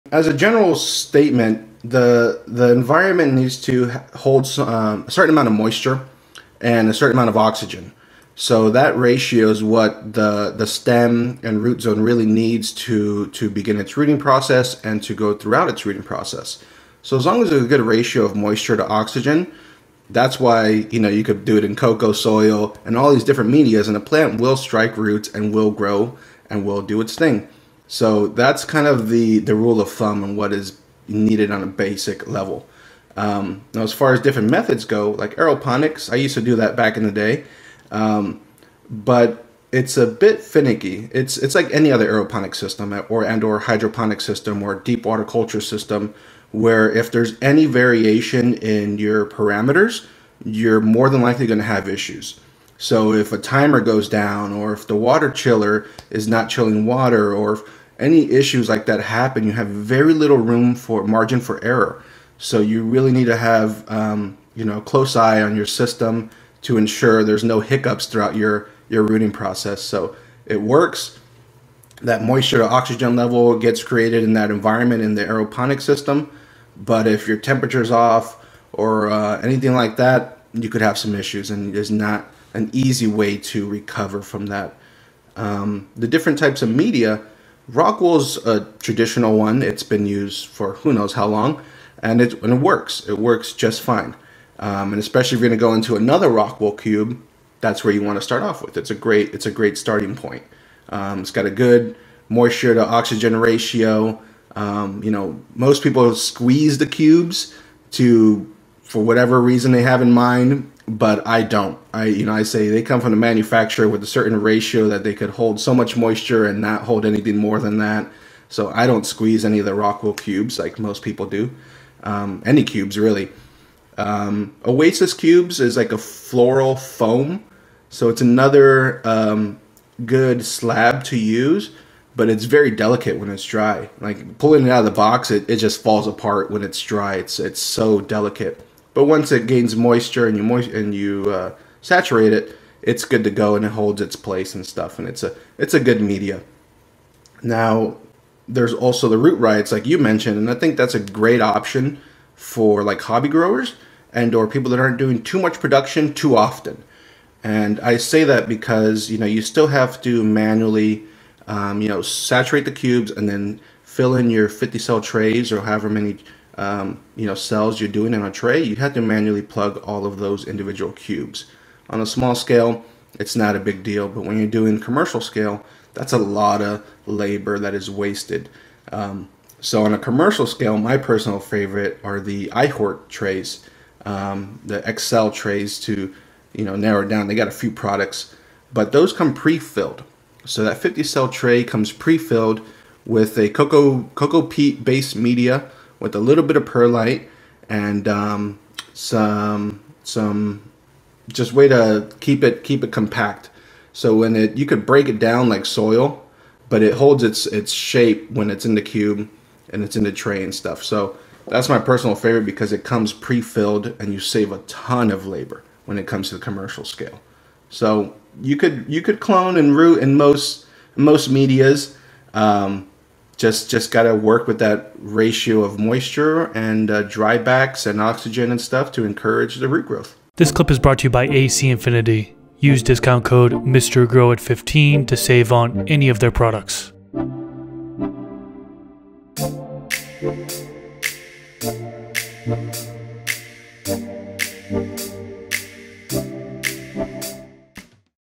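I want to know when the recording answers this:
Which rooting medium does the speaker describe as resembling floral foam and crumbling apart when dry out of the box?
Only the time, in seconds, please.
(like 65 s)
124 s.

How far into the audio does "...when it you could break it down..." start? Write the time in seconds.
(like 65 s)
204 s.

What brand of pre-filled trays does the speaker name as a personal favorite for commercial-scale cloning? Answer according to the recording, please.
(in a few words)
iHort.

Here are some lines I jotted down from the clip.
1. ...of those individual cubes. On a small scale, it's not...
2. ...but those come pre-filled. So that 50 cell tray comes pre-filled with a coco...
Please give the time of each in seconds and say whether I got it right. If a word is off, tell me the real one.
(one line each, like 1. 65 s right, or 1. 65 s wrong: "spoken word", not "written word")
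1. 170 s right
2. 188 s right.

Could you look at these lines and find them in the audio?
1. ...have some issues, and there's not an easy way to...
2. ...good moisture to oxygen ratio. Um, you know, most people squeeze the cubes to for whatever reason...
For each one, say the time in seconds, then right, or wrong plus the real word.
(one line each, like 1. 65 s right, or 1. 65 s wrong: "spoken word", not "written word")
1. 80 s right
2. 101 s right.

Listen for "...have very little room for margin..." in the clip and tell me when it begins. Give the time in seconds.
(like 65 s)
59 s.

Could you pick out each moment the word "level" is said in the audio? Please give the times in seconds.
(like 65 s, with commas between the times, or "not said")
32 s, 73 s.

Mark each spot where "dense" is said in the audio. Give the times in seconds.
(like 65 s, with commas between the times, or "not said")
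not said.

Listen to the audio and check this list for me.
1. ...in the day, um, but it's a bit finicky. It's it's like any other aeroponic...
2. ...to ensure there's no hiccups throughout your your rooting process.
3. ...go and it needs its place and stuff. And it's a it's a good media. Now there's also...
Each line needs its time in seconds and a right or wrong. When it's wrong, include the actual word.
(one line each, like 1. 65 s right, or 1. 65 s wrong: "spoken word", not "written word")
1. 36 s right
2. 66 s right
3. 143 s wrong: "holds", not "needs".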